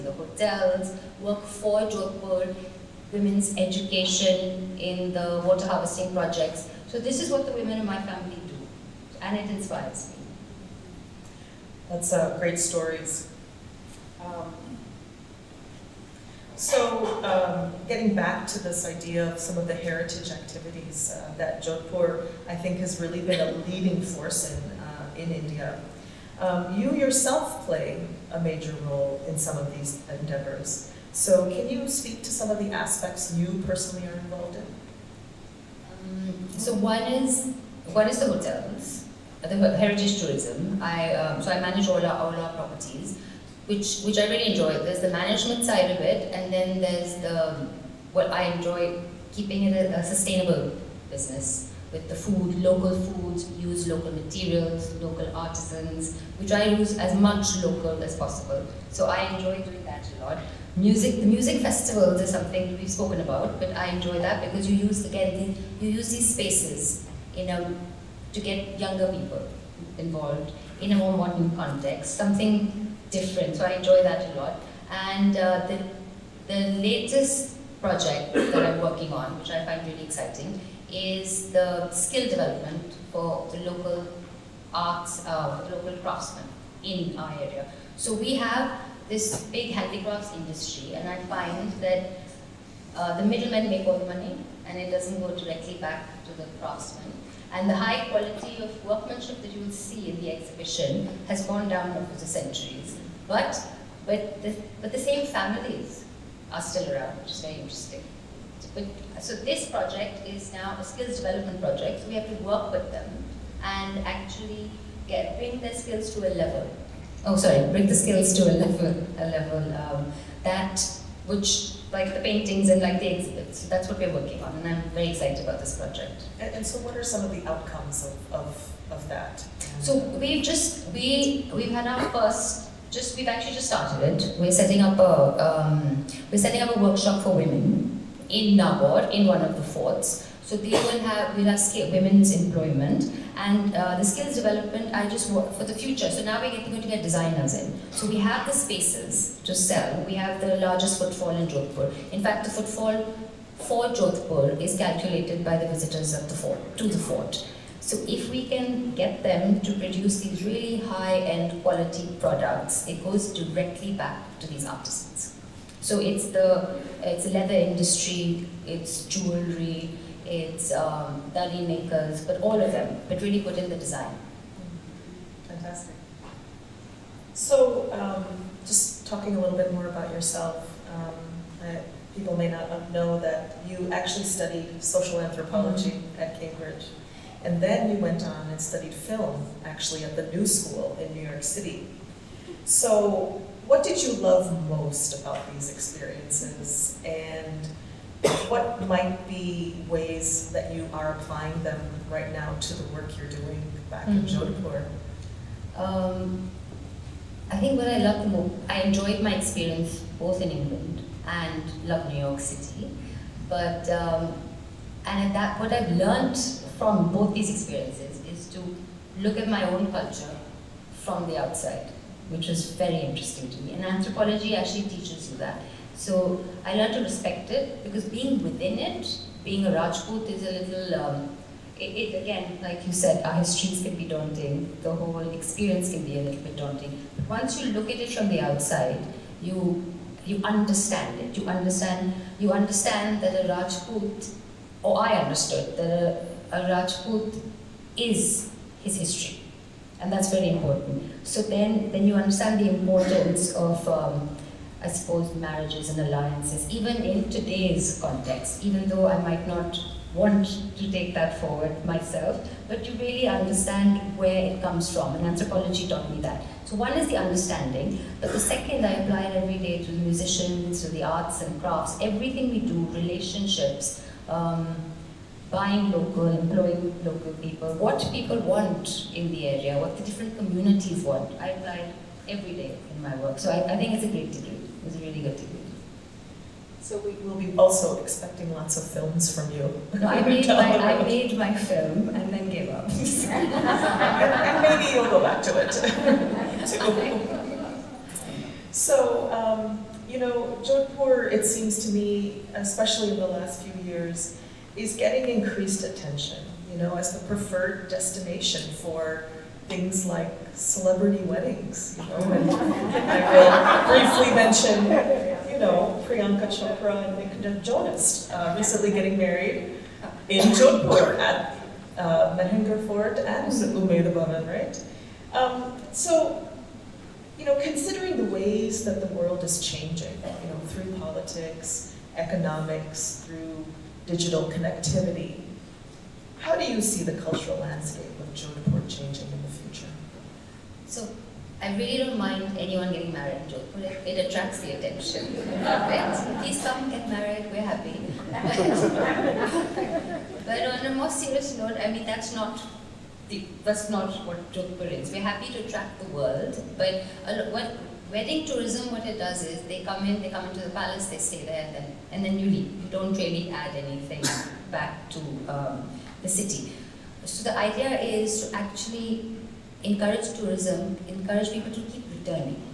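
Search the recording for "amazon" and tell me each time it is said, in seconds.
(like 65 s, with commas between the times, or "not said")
not said.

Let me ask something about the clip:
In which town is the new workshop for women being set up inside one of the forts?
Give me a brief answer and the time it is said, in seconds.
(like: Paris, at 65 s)
Nagaur, at 138 s.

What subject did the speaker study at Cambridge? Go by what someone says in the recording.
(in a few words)
social anthropology.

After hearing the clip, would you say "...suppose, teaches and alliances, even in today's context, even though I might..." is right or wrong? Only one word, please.
wrong.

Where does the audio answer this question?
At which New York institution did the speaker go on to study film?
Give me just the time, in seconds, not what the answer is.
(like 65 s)
190 s.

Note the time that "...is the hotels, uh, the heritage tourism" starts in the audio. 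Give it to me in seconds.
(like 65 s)
38 s.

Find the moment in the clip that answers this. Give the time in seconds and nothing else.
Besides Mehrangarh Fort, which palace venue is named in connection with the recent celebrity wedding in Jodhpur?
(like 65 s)
323 s.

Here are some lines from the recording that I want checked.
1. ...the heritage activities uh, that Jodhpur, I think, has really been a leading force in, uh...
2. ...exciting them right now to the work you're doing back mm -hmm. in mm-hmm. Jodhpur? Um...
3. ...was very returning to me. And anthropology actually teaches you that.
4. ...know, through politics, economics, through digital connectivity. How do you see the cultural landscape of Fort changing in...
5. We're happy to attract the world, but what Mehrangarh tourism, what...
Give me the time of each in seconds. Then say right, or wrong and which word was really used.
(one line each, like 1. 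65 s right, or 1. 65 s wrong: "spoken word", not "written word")
1. 19 s right
2. 201 s wrong: "applying", not "exciting"
3. 222 s wrong: "interesting", not "returning"
4. 330 s wrong: "Jodhpur", not "Fort"
5. 355 s wrong: "Wedding", not "Mehrangarh".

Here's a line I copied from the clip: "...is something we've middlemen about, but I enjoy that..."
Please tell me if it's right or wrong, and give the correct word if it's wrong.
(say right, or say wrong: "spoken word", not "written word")
wrong: "spoken", not "middlemen".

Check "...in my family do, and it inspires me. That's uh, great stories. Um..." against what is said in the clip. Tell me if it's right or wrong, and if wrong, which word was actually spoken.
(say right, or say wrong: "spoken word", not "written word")
right.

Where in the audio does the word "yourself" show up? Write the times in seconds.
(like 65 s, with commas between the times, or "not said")
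26 s, 180 s.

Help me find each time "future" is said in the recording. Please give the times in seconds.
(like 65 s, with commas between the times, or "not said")
145 s, 339 s.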